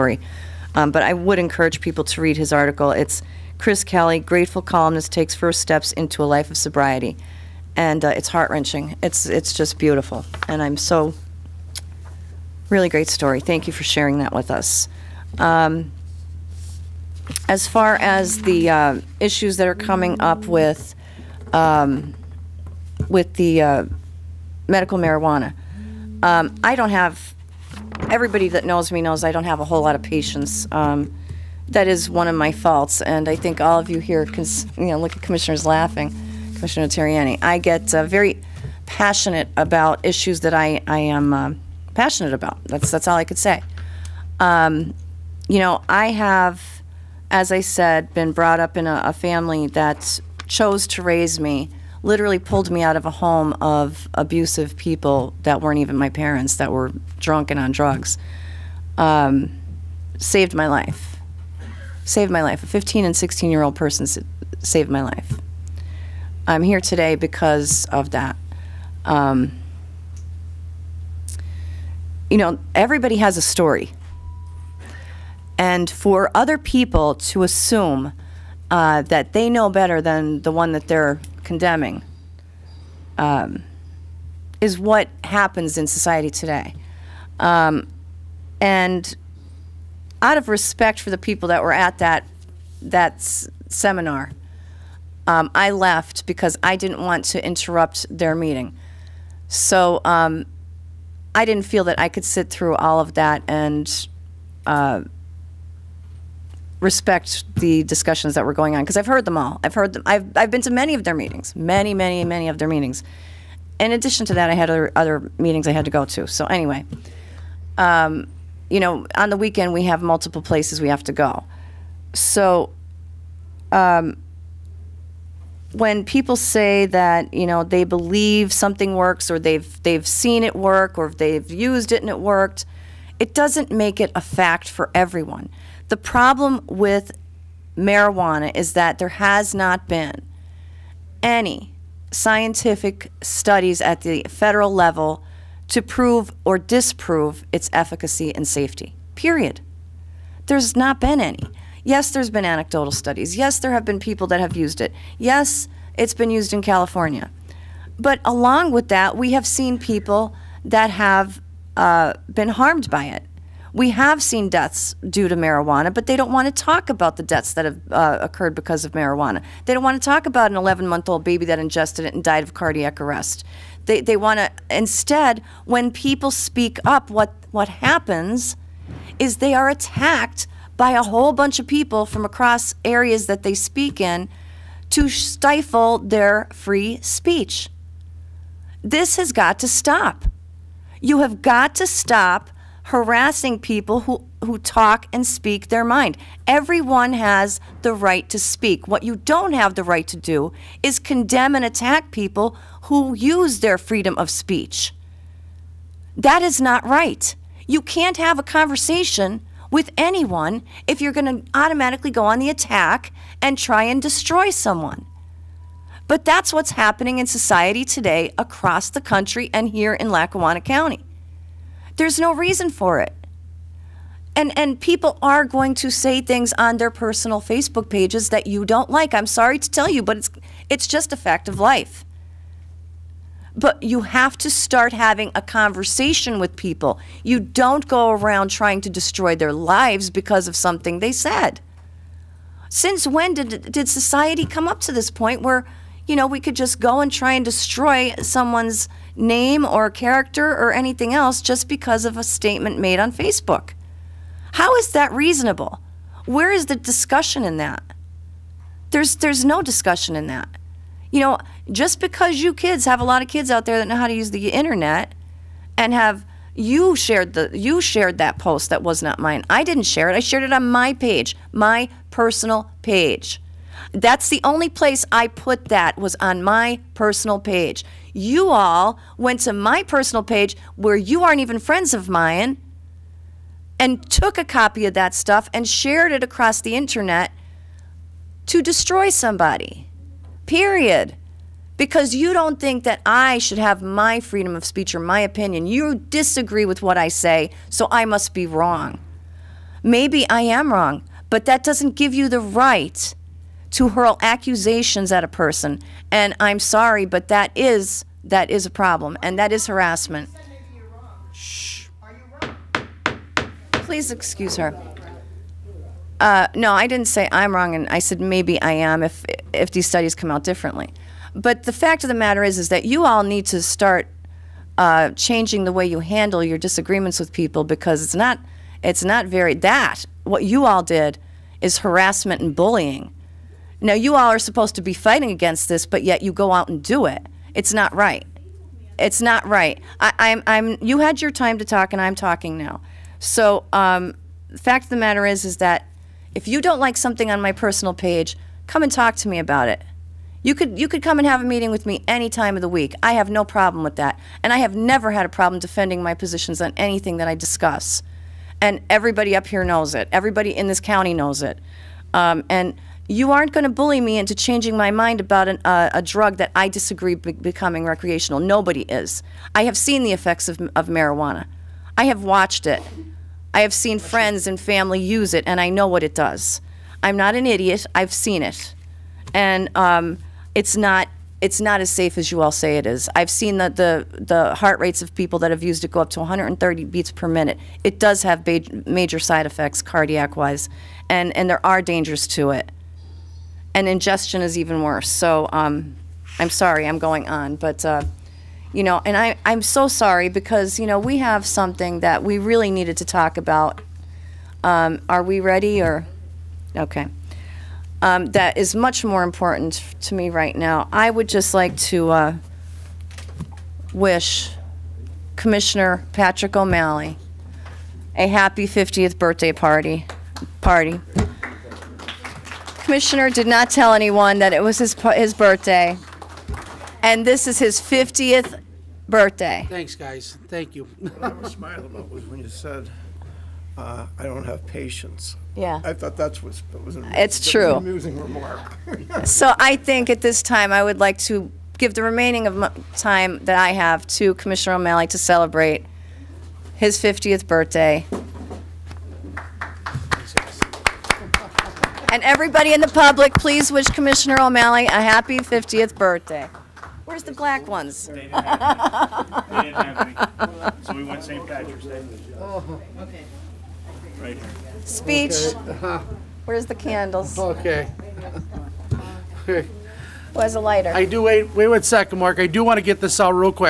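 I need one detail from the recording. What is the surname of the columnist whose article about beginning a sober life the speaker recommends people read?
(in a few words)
Kelly.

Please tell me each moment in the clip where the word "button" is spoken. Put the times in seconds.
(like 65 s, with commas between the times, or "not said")
not said.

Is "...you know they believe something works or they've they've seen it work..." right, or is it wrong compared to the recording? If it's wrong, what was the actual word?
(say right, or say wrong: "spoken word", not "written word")
right.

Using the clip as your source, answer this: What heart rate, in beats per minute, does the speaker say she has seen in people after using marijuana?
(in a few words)
130.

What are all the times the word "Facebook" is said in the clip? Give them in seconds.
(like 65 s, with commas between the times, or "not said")
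227 s, 253 s.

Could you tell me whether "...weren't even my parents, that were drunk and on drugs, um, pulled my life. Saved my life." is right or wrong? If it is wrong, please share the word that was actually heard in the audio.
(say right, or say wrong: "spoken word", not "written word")
wrong: "saved", not "pulled".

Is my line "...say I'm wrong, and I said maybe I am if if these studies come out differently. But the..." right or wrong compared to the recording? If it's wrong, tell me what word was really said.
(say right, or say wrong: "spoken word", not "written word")
right.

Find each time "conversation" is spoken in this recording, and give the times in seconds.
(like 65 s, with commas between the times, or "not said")
208 s, 235 s.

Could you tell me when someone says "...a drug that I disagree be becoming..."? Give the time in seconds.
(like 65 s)
365 s.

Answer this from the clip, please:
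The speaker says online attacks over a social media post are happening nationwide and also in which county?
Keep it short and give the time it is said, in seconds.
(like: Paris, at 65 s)
Lackawanna County, at 220 s.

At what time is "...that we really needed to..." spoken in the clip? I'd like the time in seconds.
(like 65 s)
401 s.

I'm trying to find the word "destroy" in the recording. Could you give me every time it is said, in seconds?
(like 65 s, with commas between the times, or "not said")
214 s, 238 s, 247 s, 288 s.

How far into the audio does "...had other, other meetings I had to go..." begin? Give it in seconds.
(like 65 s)
114 s.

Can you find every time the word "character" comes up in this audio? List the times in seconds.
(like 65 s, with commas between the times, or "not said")
249 s.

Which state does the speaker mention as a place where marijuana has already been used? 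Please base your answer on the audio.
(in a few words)
California.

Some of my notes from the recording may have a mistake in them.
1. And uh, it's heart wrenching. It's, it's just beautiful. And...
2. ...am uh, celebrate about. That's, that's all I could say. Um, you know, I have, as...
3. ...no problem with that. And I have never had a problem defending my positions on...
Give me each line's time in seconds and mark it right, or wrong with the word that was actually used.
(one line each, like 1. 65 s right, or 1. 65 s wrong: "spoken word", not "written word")
1. 7 s right
2. 40 s wrong: "passionate", not "celebrate"
3. 353 s right.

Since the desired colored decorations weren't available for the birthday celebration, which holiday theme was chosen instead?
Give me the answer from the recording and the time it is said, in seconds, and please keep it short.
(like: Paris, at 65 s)
St. Patrick's Day, at 461 s.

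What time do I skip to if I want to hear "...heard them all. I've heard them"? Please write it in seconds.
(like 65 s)
109 s.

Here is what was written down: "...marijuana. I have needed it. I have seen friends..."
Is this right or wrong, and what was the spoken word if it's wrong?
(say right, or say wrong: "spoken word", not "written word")
wrong: "watched", not "needed".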